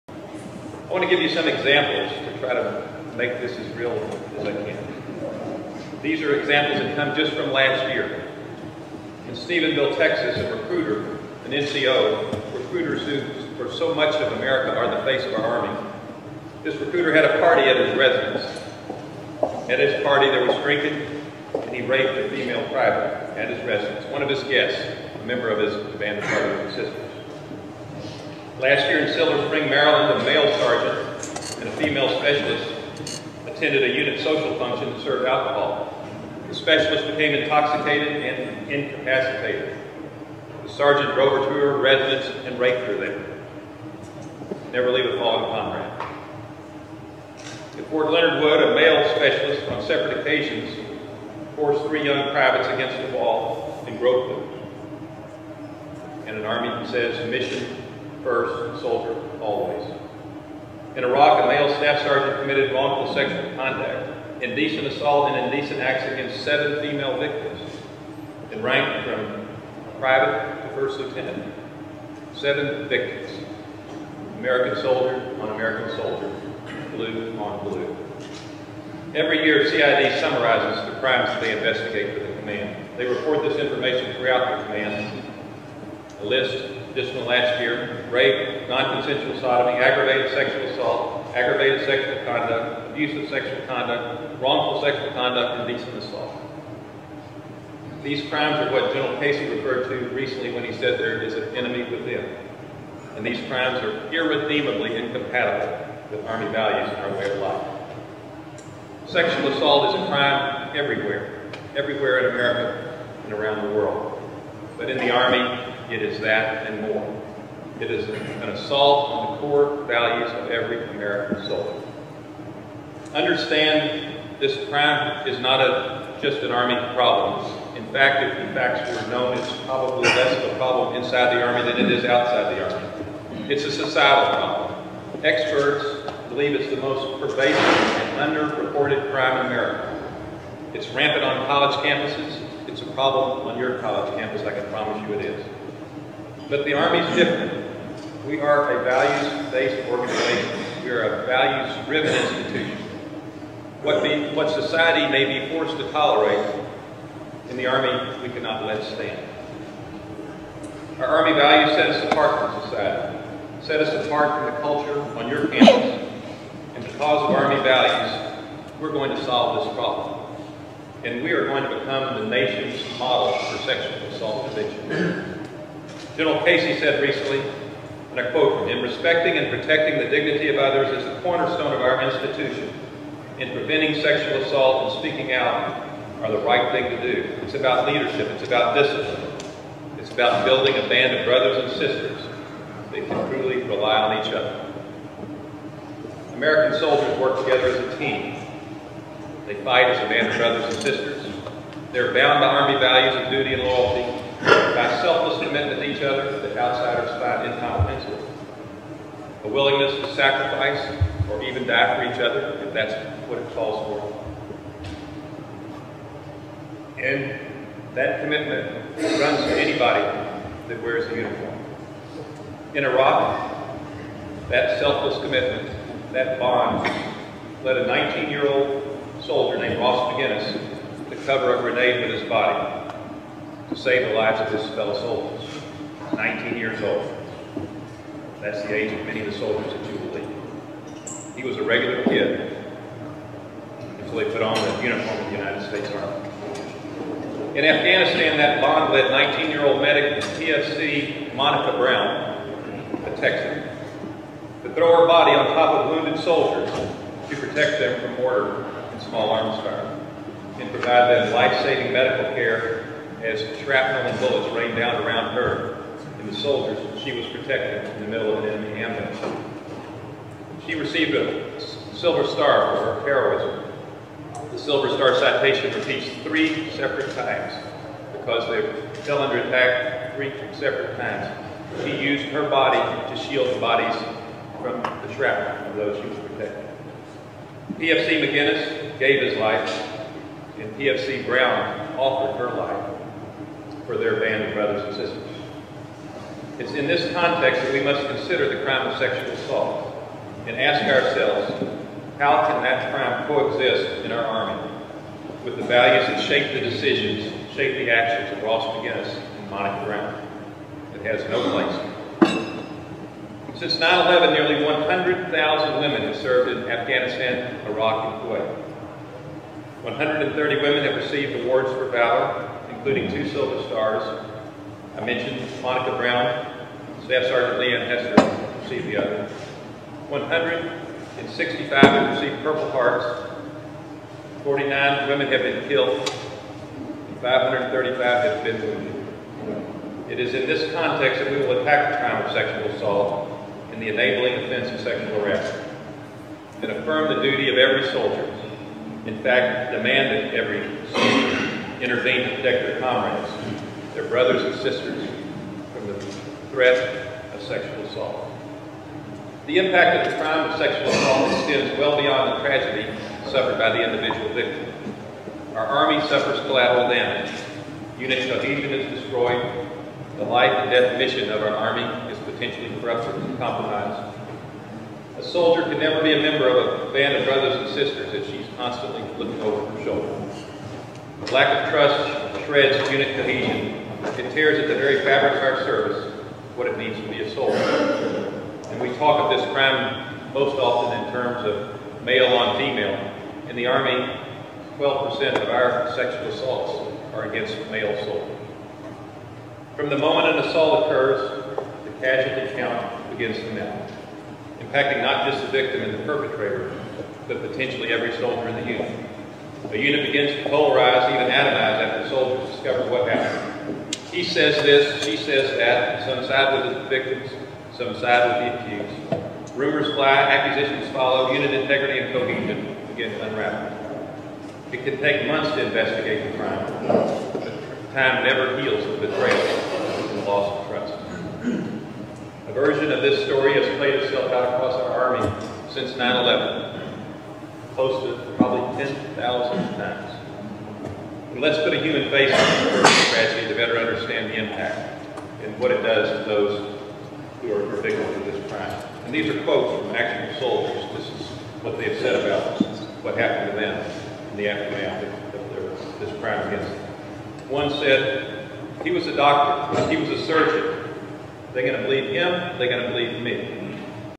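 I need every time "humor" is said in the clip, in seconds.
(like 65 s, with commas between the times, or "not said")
not said.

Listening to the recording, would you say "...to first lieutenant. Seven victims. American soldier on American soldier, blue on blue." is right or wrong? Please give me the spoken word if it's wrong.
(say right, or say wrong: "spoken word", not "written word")
right.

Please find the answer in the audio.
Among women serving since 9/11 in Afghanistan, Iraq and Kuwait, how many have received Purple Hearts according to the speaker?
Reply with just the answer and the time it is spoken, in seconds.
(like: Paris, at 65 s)
165, at 330 s.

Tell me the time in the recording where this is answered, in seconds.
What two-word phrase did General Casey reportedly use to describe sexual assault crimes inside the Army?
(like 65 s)
101 s.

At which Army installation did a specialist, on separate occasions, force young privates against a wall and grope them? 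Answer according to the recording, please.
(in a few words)
Fort Leonard Wood.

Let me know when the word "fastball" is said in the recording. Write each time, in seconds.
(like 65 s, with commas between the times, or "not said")
not said.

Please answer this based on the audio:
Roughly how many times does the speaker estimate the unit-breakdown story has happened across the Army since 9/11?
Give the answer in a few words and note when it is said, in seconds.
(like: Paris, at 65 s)
10,000, at 438 s.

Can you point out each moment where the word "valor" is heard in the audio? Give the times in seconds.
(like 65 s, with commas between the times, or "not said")
321 s.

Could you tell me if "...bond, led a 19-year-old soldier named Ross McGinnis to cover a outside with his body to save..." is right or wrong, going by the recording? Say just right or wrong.
wrong.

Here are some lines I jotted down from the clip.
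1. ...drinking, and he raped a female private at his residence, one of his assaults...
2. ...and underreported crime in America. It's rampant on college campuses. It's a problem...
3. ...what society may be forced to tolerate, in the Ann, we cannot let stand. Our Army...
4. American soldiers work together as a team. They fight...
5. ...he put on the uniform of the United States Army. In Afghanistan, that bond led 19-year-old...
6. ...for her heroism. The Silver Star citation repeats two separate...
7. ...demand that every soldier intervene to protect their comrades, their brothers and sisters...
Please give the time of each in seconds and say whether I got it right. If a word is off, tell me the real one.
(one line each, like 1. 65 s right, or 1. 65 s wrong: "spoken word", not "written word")
1. 20 s wrong: "guests", not "assaults"
2. 137 s right
3. 154 s wrong: "Army", not "Ann"
4. 196 s right
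5. 244 s right
6. 272 s wrong: "three", not "two"
7. 349 s right.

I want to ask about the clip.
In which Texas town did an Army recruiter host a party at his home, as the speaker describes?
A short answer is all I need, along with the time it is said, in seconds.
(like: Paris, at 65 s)
Stephenville, at 9 s.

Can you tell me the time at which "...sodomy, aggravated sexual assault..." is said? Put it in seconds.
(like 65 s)
89 s.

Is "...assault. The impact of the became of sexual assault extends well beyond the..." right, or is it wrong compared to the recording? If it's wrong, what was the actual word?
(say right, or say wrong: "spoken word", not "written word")
wrong: "crime", not "became".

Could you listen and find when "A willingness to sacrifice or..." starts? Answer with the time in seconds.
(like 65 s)
209 s.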